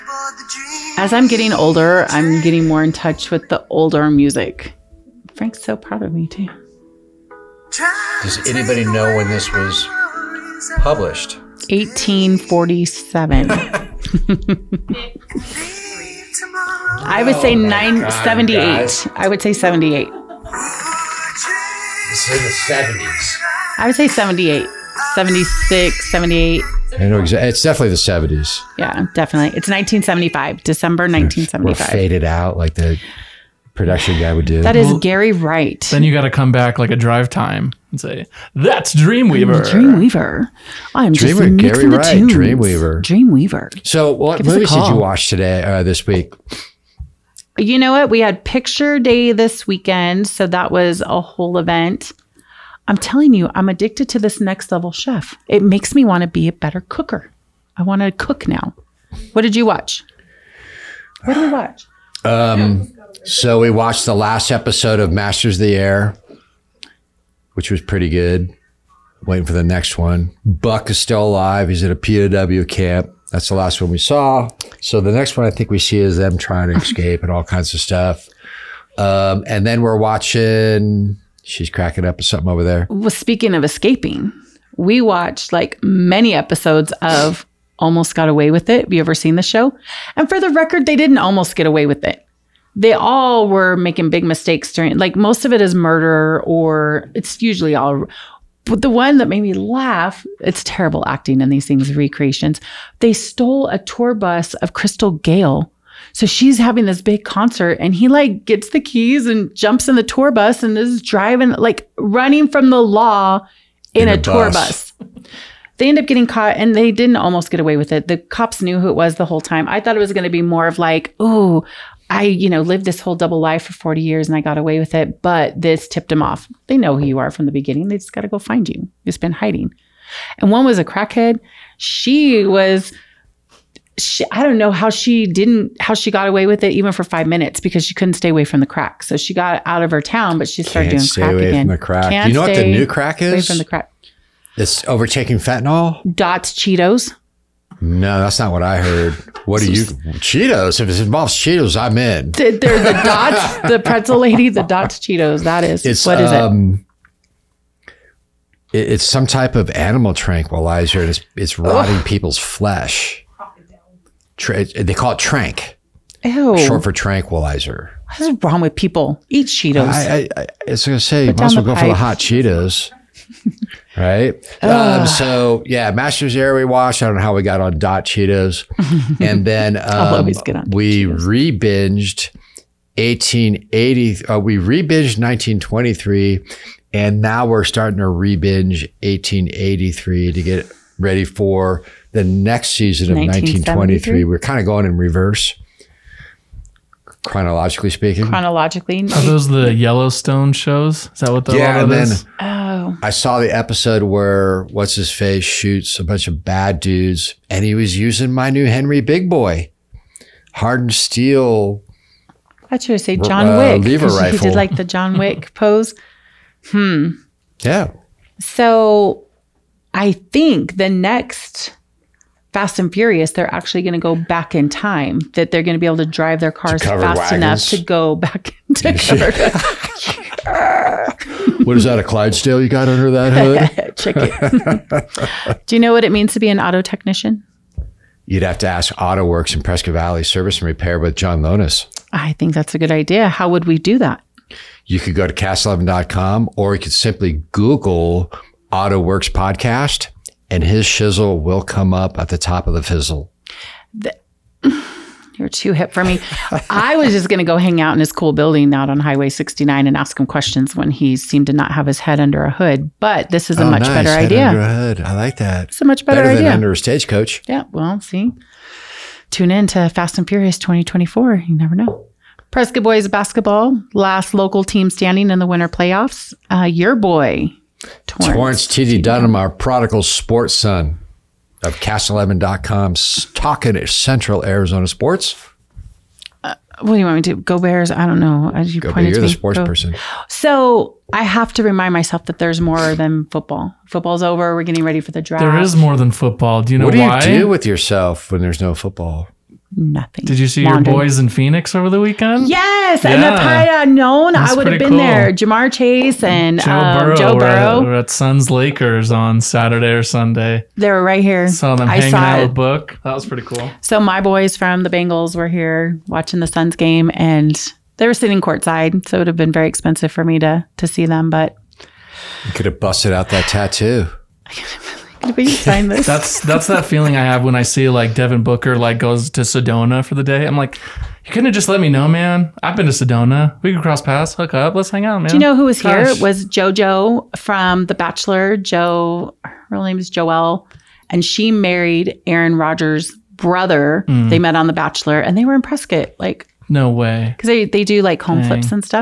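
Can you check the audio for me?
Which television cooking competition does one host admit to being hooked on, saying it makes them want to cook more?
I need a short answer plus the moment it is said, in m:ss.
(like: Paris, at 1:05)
Next Level Chef, at 0:54.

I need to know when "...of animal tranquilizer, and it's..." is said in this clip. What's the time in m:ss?
2:39.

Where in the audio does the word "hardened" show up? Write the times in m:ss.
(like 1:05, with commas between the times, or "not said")
3:30.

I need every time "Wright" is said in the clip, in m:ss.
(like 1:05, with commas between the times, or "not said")
0:35, 0:41.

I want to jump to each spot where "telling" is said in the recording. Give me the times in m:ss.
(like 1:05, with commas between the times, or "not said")
0:52.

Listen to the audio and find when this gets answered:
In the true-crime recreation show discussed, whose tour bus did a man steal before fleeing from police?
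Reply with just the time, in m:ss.
1:44.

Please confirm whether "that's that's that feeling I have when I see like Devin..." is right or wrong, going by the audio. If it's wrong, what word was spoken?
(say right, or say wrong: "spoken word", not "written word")
right.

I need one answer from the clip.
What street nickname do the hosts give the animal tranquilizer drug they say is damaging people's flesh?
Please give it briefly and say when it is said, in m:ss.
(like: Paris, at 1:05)
trank, at 2:45.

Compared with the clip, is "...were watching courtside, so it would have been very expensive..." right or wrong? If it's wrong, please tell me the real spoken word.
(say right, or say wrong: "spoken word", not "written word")
wrong: "sitting", not "watching".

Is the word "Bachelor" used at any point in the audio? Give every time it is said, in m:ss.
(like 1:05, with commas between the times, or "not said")
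5:37, 5:44.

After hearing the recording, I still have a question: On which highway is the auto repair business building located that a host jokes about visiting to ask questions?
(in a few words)
Highway 69.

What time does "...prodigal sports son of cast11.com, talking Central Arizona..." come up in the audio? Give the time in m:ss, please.
4:39.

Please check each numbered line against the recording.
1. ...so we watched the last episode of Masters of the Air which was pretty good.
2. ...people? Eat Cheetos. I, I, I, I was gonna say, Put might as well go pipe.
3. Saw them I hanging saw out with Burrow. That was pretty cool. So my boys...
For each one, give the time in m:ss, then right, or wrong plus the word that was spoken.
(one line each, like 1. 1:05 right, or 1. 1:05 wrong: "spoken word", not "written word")
1. 1:03 right
2. 2:48 right
3. 5:11 wrong: "Book", not "Burrow".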